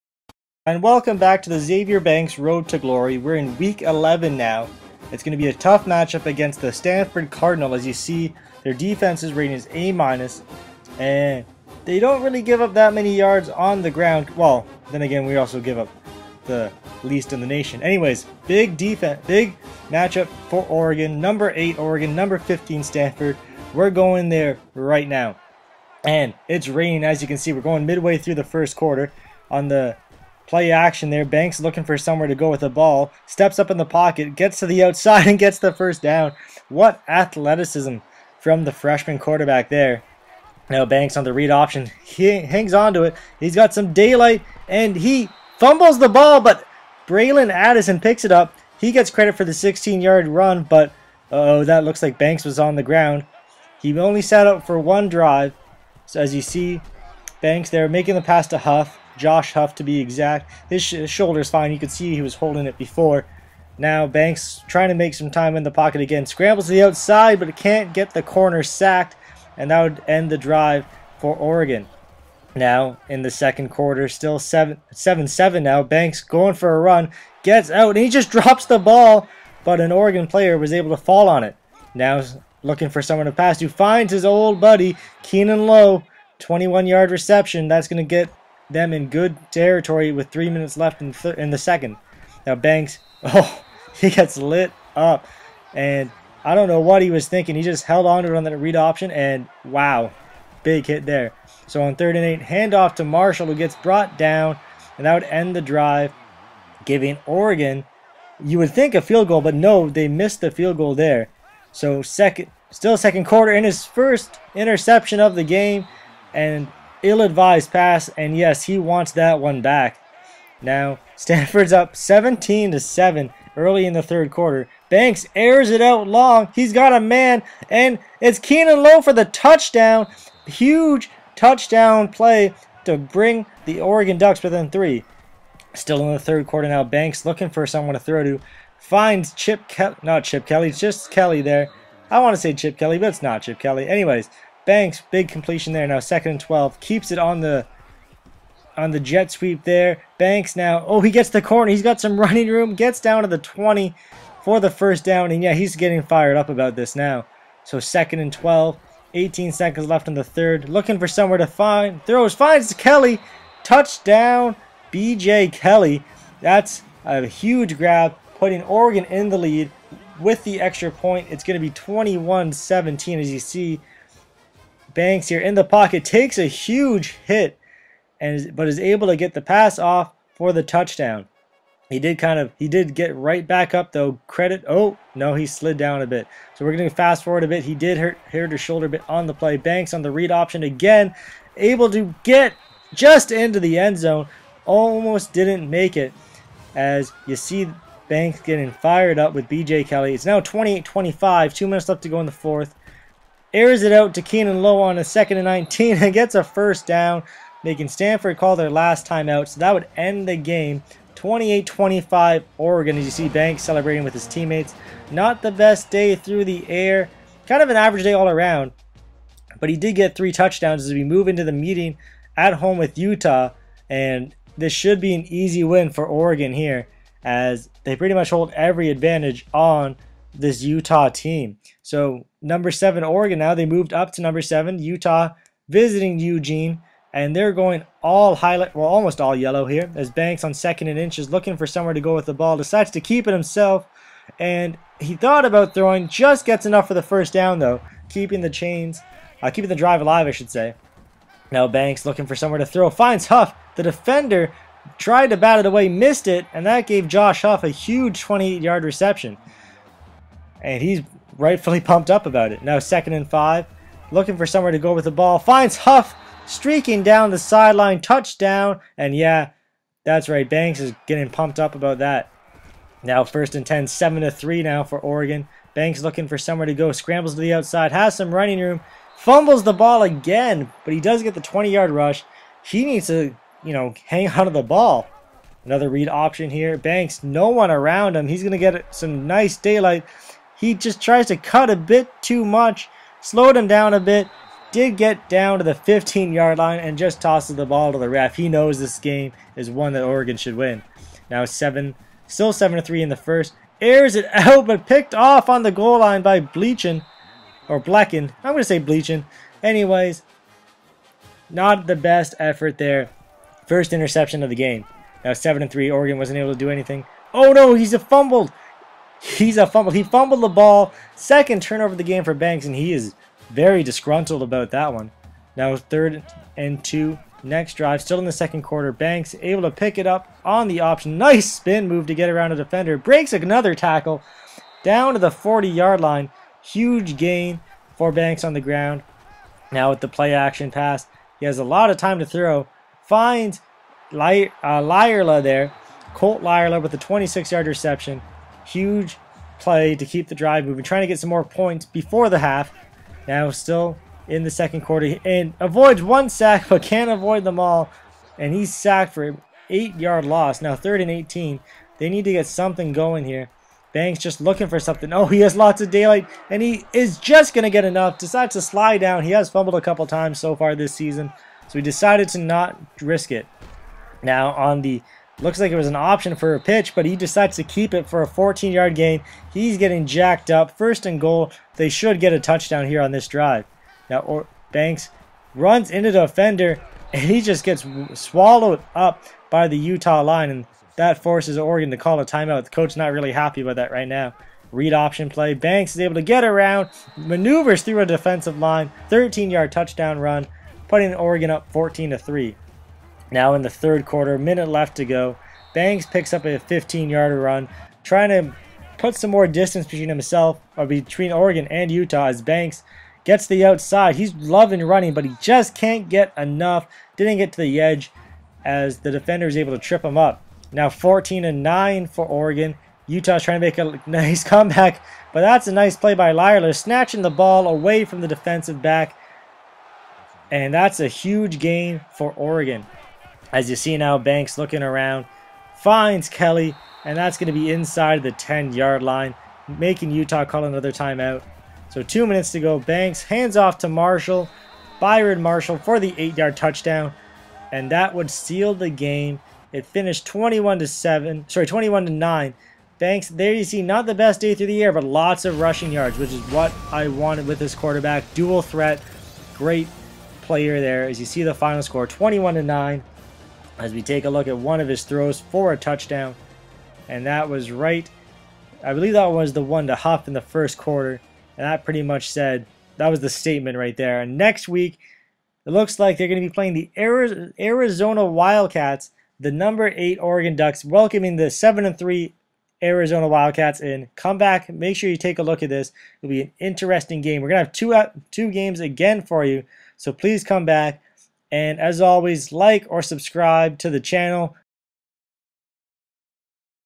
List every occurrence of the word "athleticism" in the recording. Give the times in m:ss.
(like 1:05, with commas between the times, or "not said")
0:37.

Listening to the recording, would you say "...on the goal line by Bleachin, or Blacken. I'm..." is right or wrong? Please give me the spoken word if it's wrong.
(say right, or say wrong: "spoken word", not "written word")
right.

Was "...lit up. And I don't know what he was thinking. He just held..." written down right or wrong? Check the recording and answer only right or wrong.
right.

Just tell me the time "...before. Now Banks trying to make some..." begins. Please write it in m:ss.
1:02.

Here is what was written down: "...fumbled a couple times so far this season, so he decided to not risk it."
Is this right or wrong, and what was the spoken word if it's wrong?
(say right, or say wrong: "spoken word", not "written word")
right.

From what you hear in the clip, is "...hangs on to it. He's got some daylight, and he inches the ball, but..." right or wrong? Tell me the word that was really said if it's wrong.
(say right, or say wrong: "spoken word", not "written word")
wrong: "fumbles", not "inches".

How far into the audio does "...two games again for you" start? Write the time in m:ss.
8:08.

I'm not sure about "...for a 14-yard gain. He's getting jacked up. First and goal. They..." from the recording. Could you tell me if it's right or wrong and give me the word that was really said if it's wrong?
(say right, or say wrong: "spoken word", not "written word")
right.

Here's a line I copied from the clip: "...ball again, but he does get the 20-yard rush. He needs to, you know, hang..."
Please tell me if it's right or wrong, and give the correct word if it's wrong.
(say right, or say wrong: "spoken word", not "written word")
right.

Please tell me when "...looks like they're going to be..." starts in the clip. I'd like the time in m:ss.
7:55.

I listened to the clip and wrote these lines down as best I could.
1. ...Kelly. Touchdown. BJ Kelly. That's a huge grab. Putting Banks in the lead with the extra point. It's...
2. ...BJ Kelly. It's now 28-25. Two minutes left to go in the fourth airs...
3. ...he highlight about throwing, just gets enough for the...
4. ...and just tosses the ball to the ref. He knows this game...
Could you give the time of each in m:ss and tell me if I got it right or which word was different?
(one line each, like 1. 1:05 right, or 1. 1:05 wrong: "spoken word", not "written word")
1. 2:42 wrong: "Oregon", not "Banks"
2. 3:19 right
3. 4:04 wrong: "thought", not "highlight"
4. 4:56 right.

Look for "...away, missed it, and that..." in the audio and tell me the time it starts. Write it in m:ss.
4:15.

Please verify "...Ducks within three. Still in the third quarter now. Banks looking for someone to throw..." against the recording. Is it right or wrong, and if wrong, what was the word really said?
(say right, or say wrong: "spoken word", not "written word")
right.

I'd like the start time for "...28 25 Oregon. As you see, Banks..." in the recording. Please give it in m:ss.
3:31.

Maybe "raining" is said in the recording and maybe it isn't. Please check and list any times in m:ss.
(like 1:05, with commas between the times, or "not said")
0:26.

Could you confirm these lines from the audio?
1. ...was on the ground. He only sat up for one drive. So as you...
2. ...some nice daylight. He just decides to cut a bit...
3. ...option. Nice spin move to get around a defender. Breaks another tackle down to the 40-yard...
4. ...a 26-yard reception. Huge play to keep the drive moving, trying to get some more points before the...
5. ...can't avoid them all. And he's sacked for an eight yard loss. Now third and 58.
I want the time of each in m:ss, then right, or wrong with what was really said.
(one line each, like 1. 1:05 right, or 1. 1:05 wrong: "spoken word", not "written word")
1. 0:52 right
2. 4:48 wrong: "tries", not "decides"
3. 5:30 right
4. 5:46 right
5. 5:56 wrong: "18", not "58".